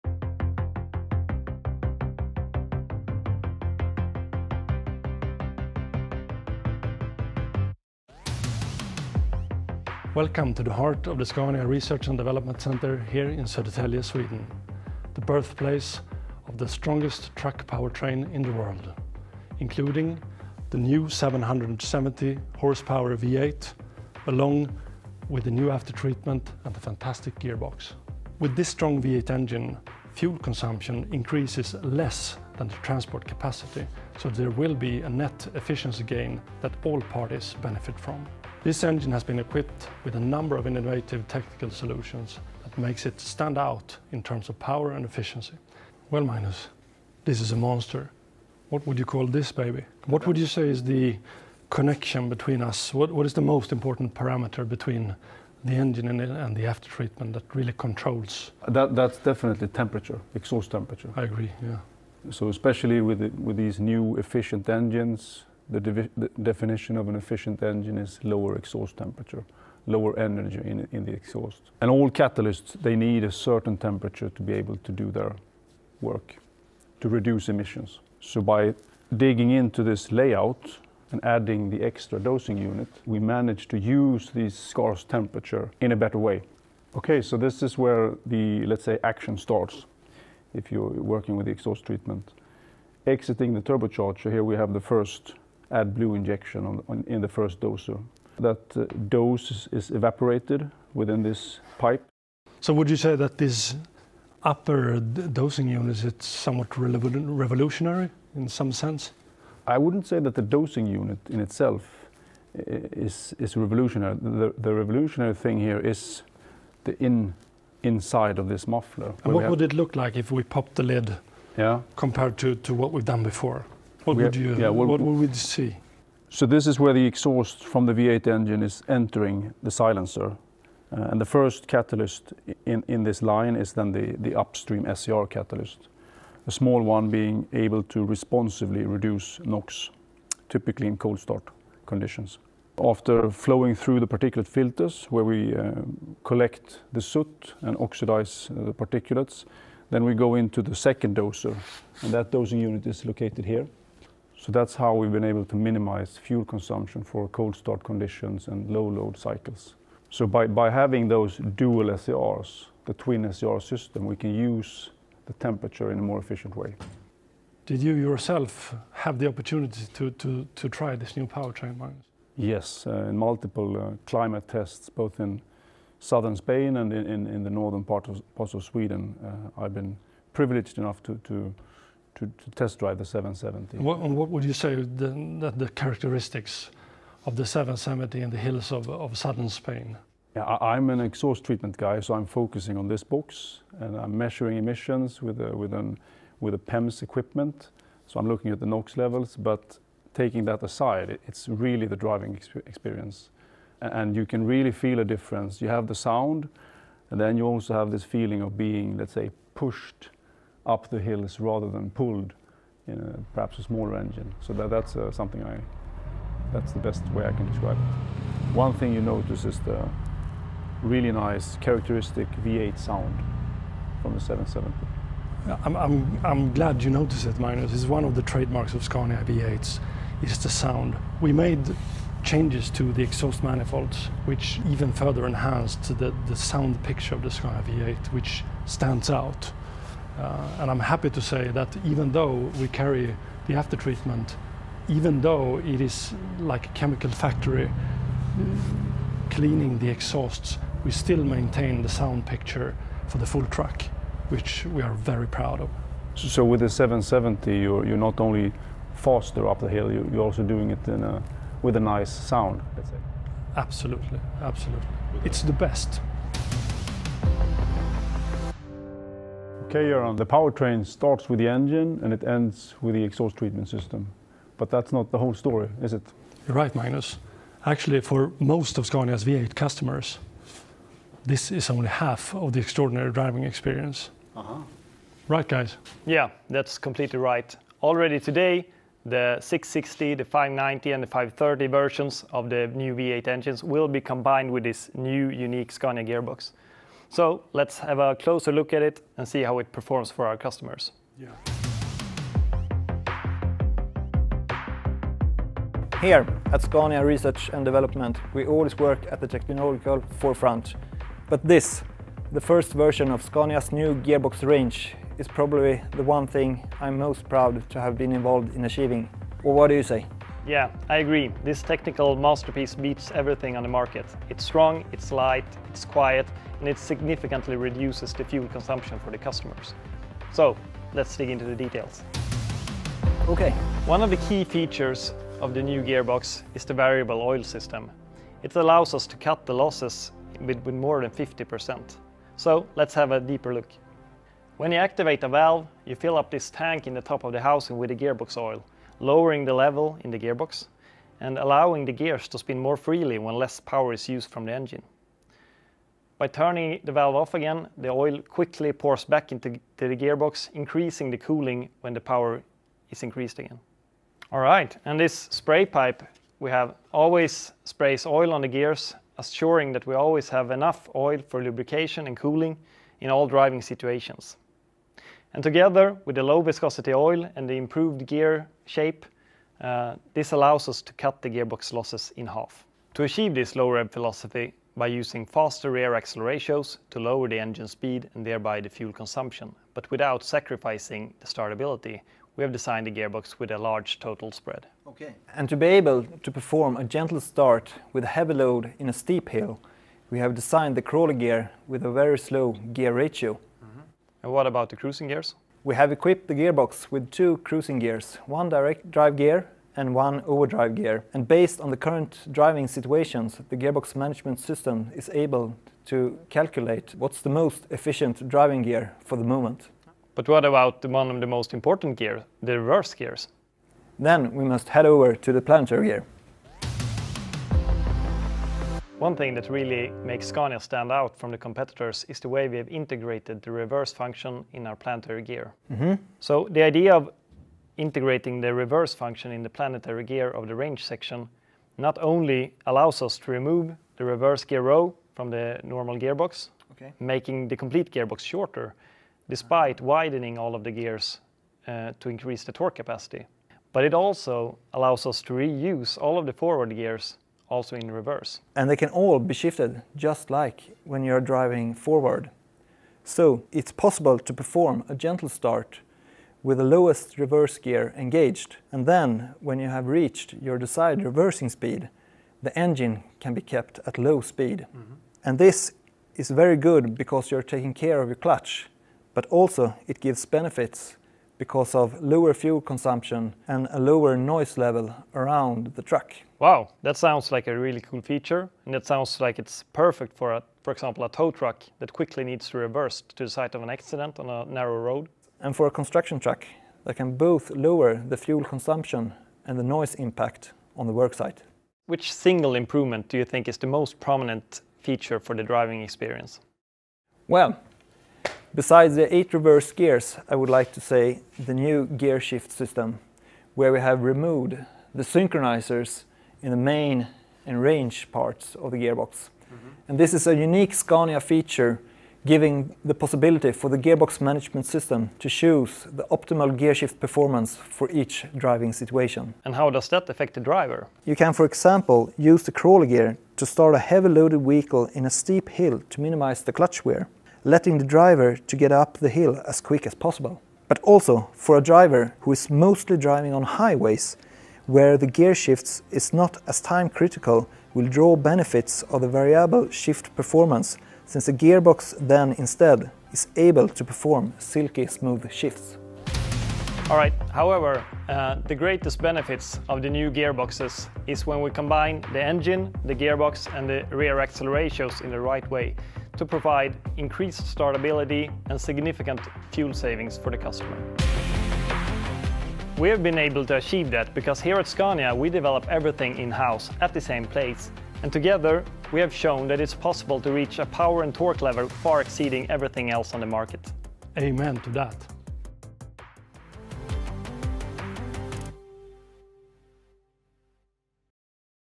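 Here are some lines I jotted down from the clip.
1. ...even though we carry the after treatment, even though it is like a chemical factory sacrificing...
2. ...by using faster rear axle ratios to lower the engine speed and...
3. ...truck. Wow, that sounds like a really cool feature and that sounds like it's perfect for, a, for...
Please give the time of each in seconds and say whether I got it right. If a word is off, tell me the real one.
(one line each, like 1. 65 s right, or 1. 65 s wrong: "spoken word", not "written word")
1. 241 s wrong: "cleaning", not "sacrificing"
2. 384 s right
3. 485 s right.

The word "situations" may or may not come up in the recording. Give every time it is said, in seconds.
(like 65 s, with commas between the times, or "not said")
373 s, 412 s, 528 s.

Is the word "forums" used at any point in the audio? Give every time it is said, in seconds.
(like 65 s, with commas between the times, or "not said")
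not said.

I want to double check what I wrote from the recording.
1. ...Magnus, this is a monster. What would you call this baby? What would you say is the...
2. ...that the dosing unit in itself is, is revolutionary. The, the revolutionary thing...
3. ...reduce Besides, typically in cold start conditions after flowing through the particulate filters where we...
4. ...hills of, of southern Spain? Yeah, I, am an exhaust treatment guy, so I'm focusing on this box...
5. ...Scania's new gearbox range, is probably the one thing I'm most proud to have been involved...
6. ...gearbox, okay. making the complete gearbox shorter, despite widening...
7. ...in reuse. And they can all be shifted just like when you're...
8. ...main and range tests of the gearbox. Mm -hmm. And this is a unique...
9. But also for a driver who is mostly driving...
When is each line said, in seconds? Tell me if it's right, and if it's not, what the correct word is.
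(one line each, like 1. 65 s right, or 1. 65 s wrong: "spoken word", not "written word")
1. 46 s right
2. 110 s right
3. 138 s wrong: "NOx", not "Besides"
4. 188 s right
5. 313 s right
6. 445 s right
7. 457 s wrong: "reverse", not "reuse"
8. 516 s wrong: "parts", not "tests"
9. 540 s right.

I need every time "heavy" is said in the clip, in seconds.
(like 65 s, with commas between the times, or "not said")
398 s, 533 s.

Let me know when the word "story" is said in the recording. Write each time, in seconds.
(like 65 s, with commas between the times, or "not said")
275 s.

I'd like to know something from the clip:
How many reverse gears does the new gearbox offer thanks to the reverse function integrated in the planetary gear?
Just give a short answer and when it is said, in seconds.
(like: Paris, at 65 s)
8, at 509 s.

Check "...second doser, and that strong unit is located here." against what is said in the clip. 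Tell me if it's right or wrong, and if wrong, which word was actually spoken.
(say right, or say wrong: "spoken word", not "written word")
wrong: "dosing", not "strong".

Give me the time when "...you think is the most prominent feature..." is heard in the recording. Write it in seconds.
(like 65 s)
503 s.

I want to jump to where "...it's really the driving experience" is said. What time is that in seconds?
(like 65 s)
201 s.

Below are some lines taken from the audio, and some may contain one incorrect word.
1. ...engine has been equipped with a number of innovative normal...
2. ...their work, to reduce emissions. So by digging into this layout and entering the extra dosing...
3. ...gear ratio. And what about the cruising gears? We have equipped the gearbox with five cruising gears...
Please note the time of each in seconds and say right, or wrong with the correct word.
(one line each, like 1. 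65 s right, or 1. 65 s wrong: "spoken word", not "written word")
1. 38 s wrong: "technical", not "normal"
2. 75 s wrong: "adding", not "entering"
3. 402 s wrong: "two", not "five".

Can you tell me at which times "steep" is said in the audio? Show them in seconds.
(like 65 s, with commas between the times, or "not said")
398 s, 535 s.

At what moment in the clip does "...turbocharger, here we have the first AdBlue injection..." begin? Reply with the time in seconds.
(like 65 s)
93 s.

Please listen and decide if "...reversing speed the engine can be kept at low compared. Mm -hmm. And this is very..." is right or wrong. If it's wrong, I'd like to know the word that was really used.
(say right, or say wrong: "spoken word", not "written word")
wrong: "speed", not "compared".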